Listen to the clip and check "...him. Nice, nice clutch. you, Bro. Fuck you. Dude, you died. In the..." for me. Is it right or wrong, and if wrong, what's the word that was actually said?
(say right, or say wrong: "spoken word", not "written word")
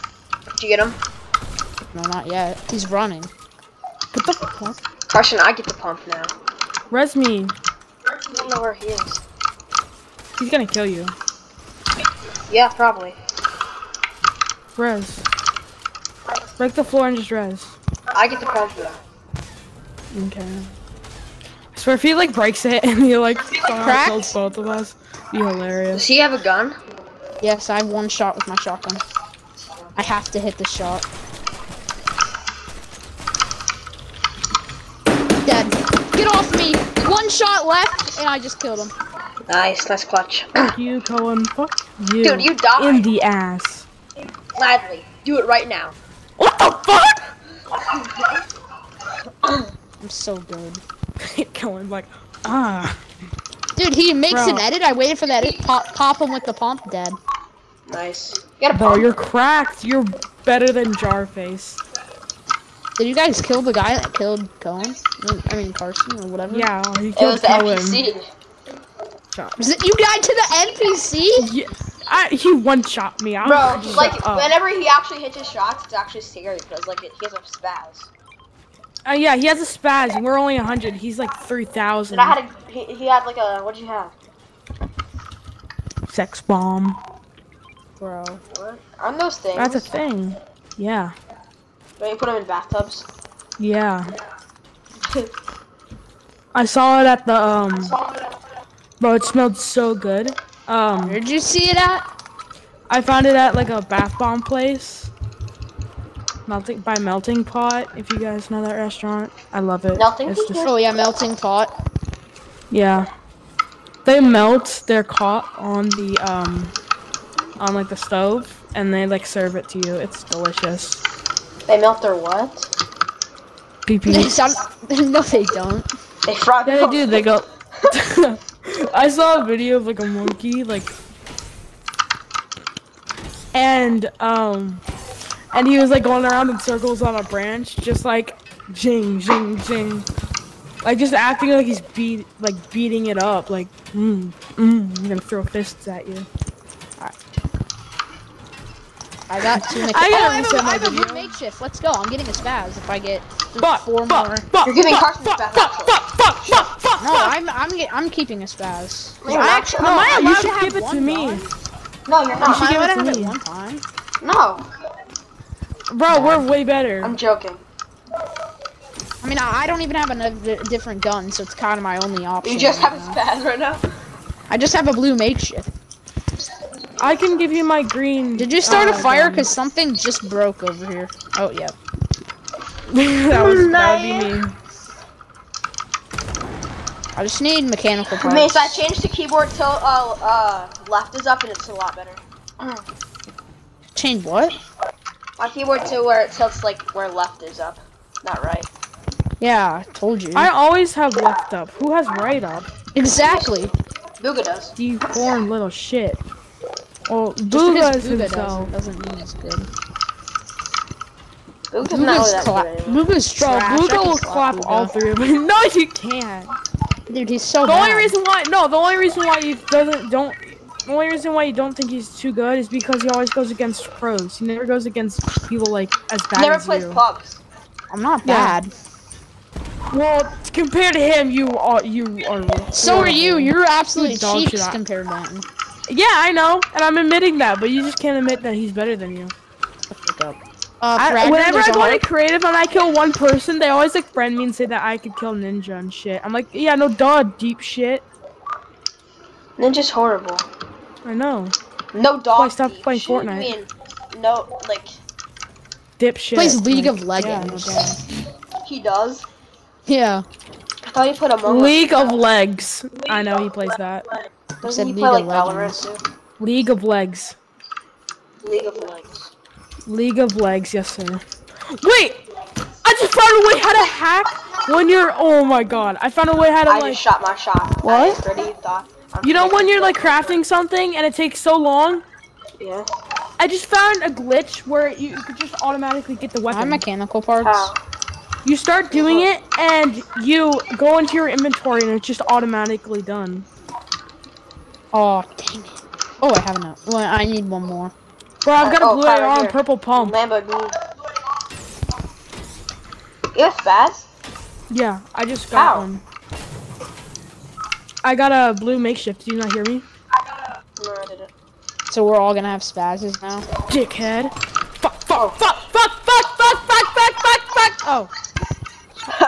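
wrong: "Coen", not "Bro".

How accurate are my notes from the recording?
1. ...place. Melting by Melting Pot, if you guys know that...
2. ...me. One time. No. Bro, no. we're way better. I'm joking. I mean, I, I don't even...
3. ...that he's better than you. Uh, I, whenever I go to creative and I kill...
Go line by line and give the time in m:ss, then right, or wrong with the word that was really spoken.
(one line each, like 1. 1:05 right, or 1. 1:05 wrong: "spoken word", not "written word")
1. 1:44 right
2. 2:43 right
3. 3:58 right.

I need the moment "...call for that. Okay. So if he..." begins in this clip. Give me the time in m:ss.
0:18.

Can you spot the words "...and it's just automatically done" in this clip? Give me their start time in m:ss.
4:51.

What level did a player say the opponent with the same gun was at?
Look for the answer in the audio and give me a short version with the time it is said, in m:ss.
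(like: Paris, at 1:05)
3,000, at 1:20.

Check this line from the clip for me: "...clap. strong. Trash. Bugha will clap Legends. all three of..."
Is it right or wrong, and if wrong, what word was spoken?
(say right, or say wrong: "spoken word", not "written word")
wrong: "Bugha", not "Legends".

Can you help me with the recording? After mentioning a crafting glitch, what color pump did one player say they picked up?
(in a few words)
Purple.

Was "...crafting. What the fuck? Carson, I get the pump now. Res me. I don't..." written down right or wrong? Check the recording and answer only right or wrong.
wrong.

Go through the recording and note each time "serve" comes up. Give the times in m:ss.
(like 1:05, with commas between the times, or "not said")
1:59.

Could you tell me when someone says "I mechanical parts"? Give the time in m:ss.
4:46.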